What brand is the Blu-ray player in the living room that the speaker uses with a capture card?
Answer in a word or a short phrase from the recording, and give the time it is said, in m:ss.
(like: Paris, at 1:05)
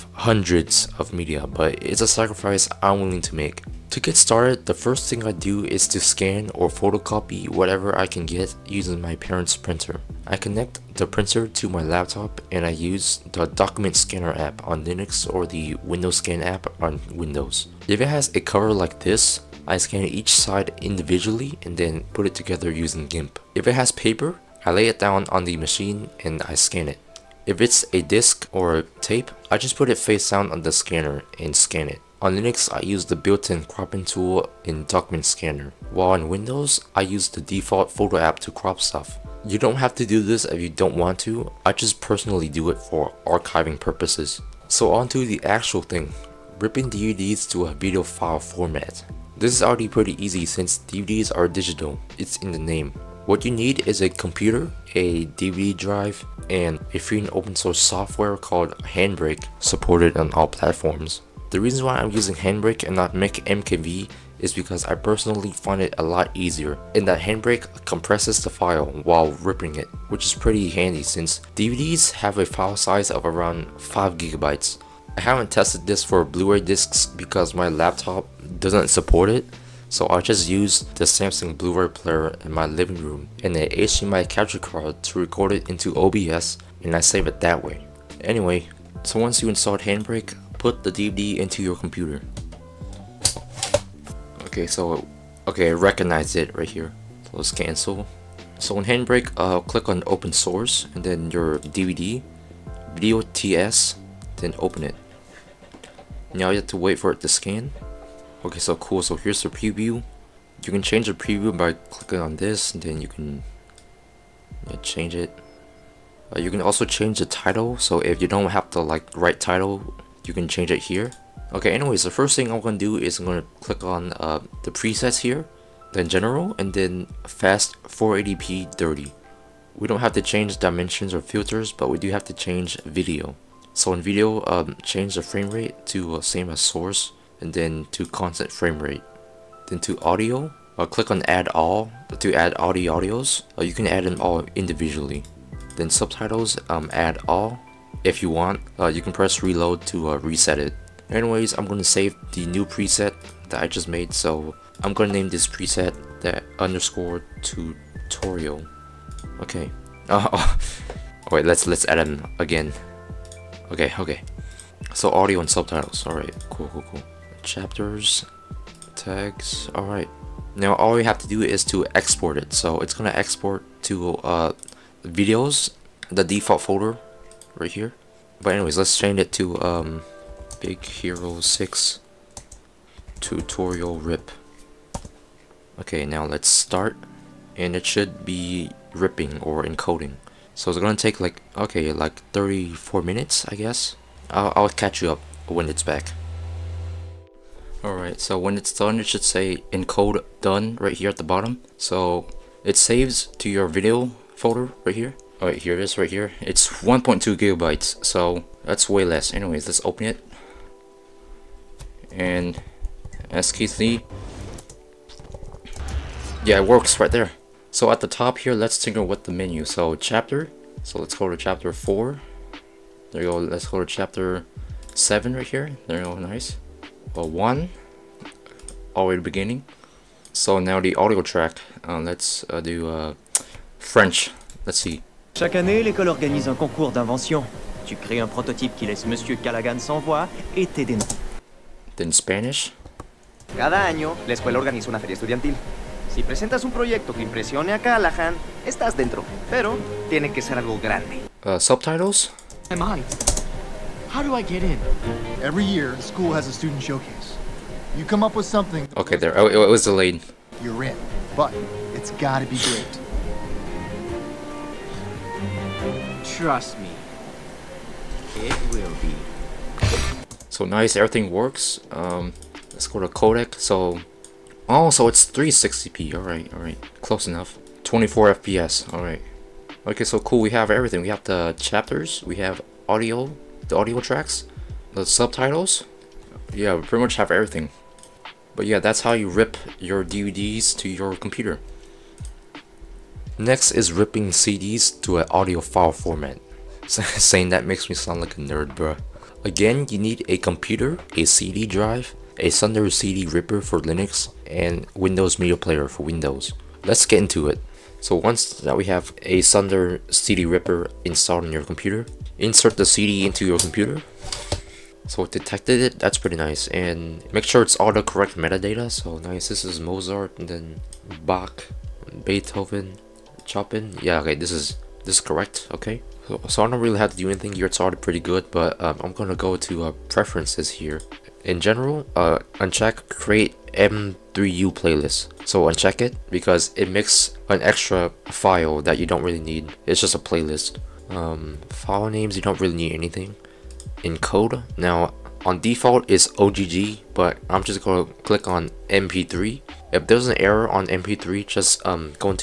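Samsung, at 1:21.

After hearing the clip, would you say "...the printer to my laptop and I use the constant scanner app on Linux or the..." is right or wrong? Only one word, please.
wrong.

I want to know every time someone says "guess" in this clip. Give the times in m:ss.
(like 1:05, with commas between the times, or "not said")
3:13.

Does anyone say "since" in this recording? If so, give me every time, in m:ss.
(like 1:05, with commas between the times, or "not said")
0:50, 1:11.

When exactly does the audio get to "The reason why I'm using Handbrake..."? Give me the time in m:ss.
1:01.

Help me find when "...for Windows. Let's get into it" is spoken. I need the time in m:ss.
5:05.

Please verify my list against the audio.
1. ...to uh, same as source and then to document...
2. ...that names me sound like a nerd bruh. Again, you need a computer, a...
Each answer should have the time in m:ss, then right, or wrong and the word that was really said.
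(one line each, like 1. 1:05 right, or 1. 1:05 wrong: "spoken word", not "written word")
1. 2:15 wrong: "constant", not "document"
2. 4:57 wrong: "makes", not "names".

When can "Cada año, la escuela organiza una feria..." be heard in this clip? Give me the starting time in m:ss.
4:03.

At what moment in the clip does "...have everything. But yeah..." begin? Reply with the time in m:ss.
4:47.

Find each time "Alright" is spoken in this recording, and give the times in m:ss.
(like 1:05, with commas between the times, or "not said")
3:17, 3:25.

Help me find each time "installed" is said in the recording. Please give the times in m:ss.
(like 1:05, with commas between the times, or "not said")
1:29, 5:11.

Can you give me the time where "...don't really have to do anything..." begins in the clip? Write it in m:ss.
5:26.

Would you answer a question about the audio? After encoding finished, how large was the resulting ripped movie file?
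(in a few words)
1.2 gigabytes.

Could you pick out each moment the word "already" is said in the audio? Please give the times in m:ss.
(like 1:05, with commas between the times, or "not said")
0:49, 3:48, 5:27.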